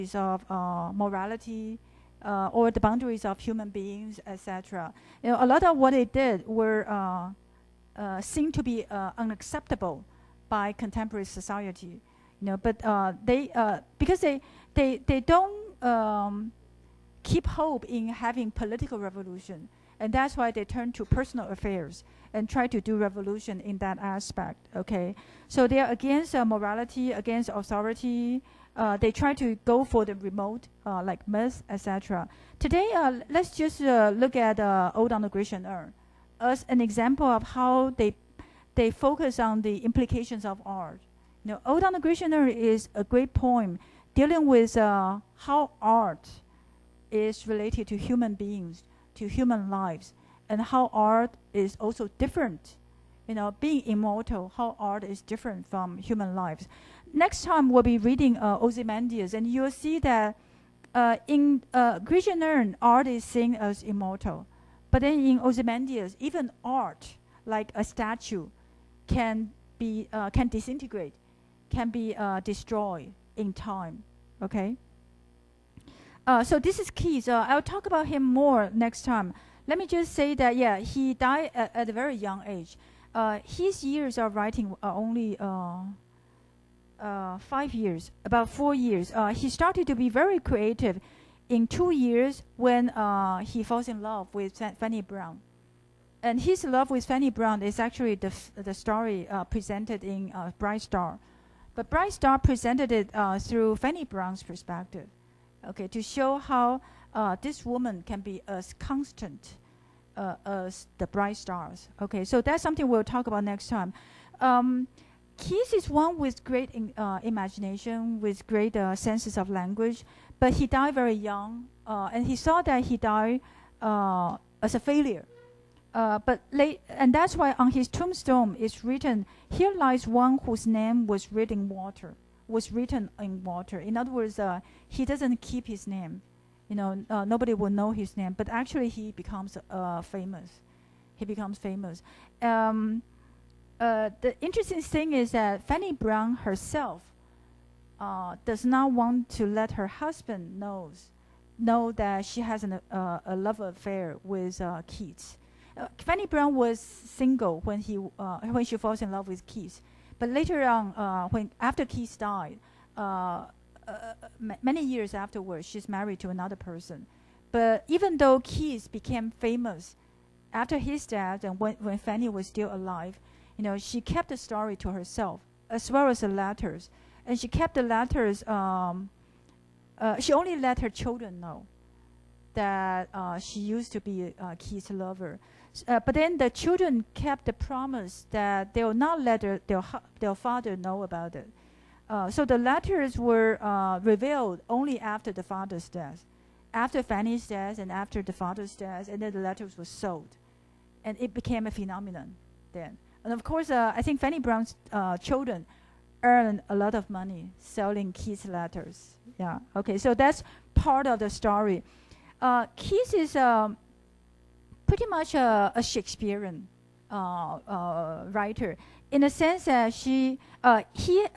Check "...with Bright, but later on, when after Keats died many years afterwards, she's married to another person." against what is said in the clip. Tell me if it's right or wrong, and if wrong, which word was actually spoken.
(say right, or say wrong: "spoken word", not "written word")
wrong: "Keats", not "Bright".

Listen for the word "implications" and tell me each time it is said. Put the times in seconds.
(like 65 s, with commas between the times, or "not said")
39 s.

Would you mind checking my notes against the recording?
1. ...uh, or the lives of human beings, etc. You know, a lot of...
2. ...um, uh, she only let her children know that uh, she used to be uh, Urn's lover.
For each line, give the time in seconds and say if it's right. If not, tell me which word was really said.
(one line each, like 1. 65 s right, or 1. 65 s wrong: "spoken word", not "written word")
1. 2 s wrong: "boundaries", not "lives"
2. 178 s wrong: "Keats", not "Urn".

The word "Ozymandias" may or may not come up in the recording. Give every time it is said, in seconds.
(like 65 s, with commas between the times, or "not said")
58 s, 65 s.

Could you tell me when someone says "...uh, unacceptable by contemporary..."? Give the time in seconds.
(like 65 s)
8 s.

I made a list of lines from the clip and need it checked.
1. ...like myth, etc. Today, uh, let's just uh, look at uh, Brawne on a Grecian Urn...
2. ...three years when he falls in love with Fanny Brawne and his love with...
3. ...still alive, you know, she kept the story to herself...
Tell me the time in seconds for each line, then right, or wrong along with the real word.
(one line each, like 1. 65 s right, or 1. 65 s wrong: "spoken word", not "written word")
1. 31 s wrong: "Ode", not "Brawne"
2. 91 s wrong: "two", not "three"
3. 172 s right.